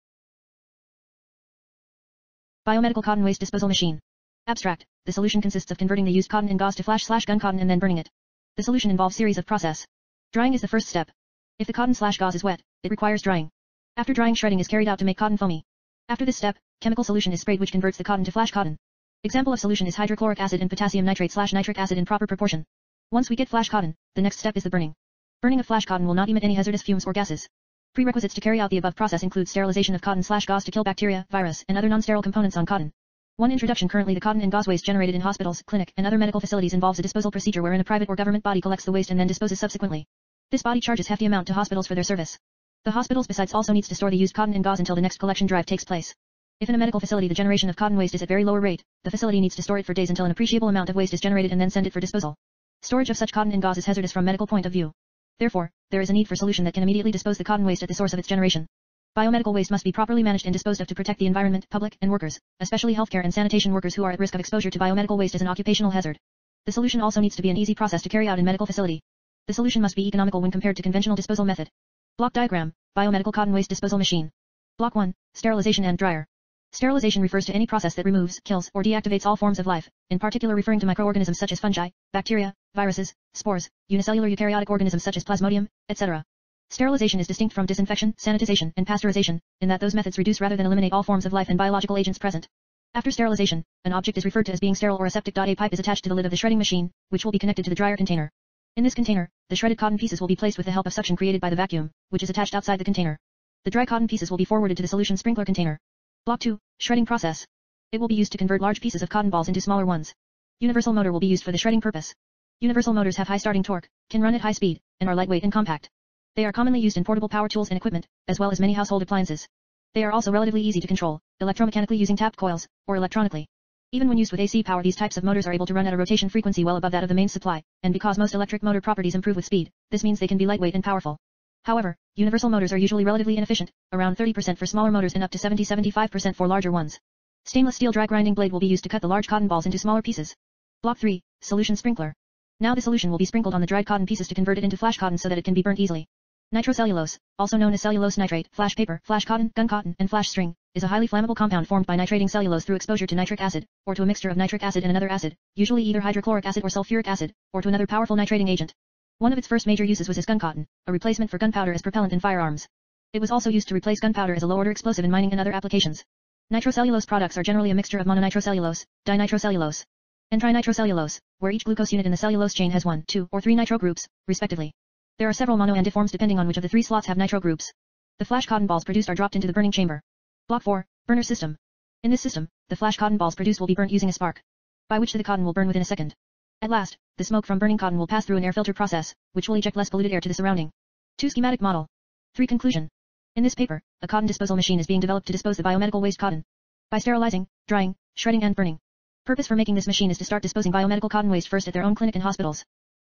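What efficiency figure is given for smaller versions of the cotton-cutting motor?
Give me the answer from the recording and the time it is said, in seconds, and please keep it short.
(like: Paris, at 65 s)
30%, at 134 s.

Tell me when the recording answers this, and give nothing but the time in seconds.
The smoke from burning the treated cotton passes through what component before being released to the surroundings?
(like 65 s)
188 s.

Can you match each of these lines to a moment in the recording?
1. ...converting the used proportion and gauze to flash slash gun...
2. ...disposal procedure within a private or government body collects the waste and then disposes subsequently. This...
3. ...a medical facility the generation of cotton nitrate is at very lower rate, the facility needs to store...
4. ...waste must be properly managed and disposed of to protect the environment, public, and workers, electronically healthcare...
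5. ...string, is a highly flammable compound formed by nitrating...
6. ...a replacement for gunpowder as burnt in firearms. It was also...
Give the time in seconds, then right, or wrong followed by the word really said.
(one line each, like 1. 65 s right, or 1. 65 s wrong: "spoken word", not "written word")
1. 5 s wrong: "cotton", not "proportion"
2. 37 s wrong: "wherein", not "within"
3. 46 s wrong: "waste", not "nitrate"
4. 59 s wrong: "especially", not "electronically"
5. 150 s right
6. 160 s wrong: "propellant", not "burnt".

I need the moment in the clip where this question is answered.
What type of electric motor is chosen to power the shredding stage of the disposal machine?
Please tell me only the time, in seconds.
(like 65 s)
110 s.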